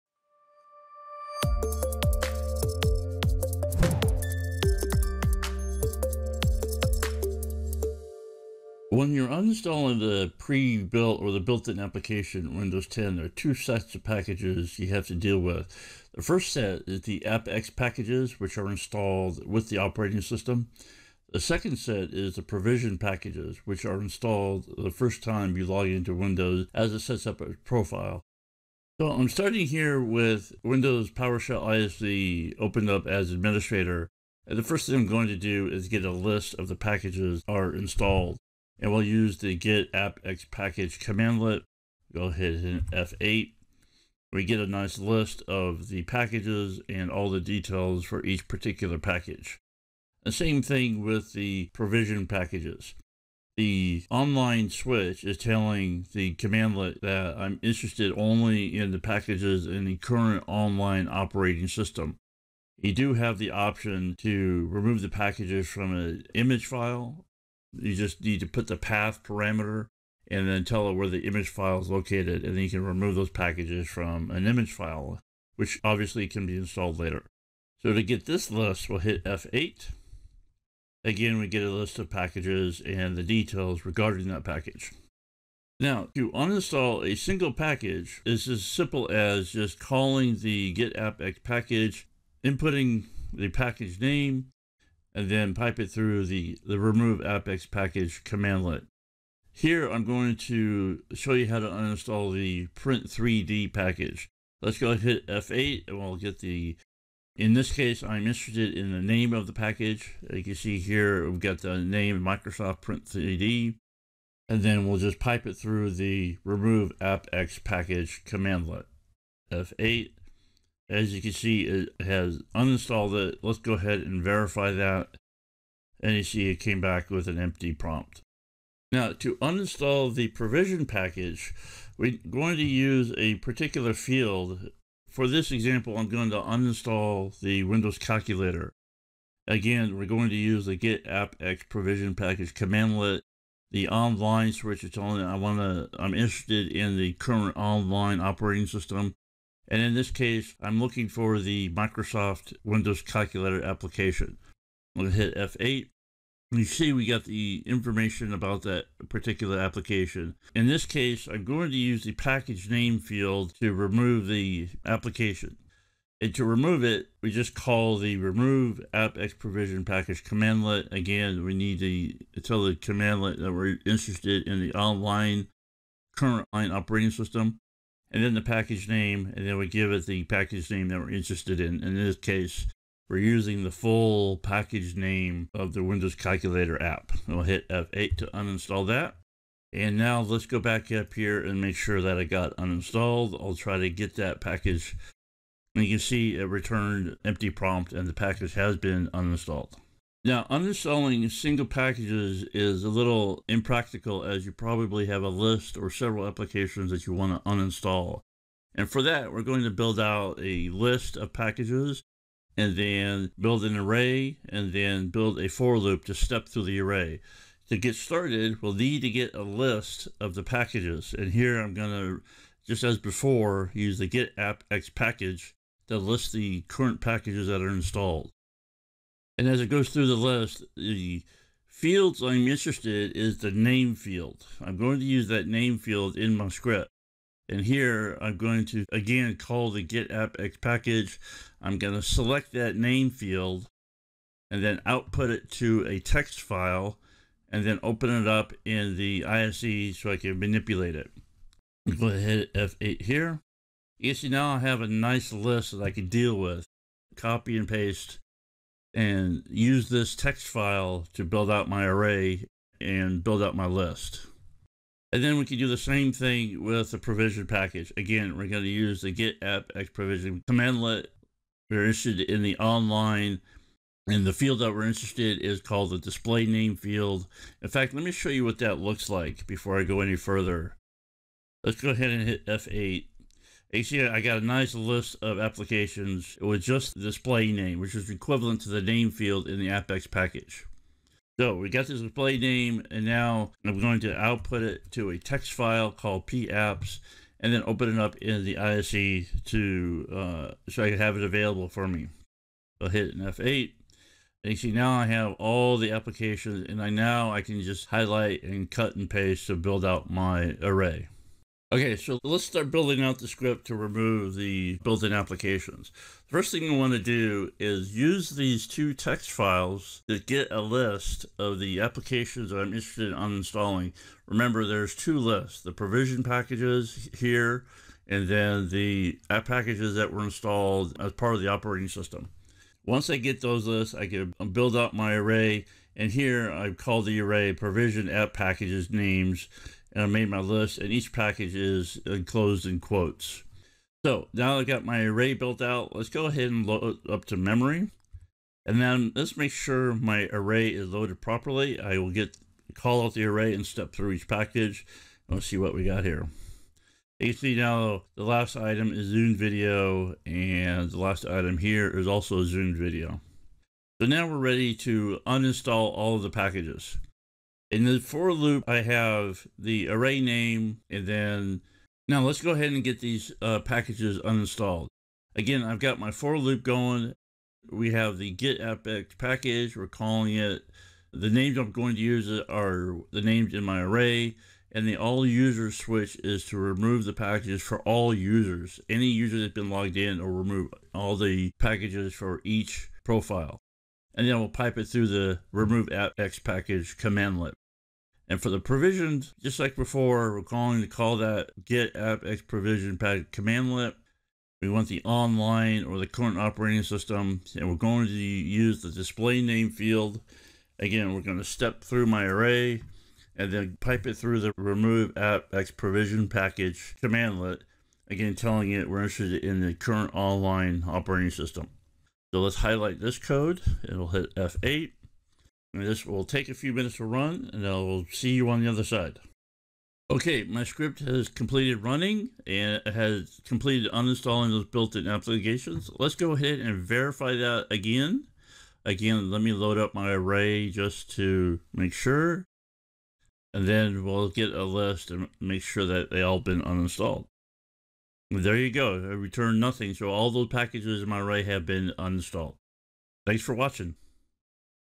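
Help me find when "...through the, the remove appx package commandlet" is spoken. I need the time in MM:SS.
01:35.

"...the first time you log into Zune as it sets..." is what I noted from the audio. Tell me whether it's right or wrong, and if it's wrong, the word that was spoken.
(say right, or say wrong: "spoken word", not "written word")
wrong: "Windows", not "Zune".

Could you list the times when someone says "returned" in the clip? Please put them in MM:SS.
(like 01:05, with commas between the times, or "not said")
03:16, 07:29.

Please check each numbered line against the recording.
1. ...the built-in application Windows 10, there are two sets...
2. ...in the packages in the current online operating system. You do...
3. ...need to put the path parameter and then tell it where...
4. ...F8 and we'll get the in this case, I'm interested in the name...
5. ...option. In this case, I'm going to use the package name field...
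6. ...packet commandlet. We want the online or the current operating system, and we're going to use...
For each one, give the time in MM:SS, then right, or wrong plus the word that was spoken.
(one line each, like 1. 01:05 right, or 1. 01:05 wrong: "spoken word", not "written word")
1. 00:11 right
2. 00:58 right
3. 01:08 right
4. 01:45 right
5. 02:39 wrong: "application", not "option"
6. 06:42 right.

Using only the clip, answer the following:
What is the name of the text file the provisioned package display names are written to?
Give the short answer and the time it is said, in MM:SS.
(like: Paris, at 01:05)
PApps, at 04:56.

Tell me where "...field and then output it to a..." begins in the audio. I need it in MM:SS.
04:03.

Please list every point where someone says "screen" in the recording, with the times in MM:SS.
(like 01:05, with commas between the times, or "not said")
not said.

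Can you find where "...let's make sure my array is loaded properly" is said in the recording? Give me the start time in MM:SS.
05:49.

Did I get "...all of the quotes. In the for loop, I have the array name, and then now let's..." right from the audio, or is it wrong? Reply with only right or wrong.
wrong.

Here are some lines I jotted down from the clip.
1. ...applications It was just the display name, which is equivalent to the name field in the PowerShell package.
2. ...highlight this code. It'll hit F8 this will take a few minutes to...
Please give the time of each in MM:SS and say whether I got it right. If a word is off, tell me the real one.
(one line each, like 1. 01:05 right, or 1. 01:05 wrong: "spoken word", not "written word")
1. 04:45 wrong: "AppX", not "PowerShell"
2. 07:02 right.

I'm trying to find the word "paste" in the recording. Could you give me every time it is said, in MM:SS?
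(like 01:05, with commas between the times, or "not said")
04:17, 05:09.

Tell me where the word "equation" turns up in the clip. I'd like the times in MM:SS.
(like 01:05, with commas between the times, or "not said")
not said.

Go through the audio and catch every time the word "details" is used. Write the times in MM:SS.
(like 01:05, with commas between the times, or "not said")
00:47, 01:23.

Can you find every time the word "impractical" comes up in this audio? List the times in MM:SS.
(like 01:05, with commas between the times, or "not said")
03:23.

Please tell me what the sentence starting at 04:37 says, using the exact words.
In fact, let me show you what that looks like before I go any further.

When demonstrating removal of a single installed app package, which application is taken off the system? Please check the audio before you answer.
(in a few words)
Print 3D.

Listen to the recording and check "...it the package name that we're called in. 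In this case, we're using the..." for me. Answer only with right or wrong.
wrong.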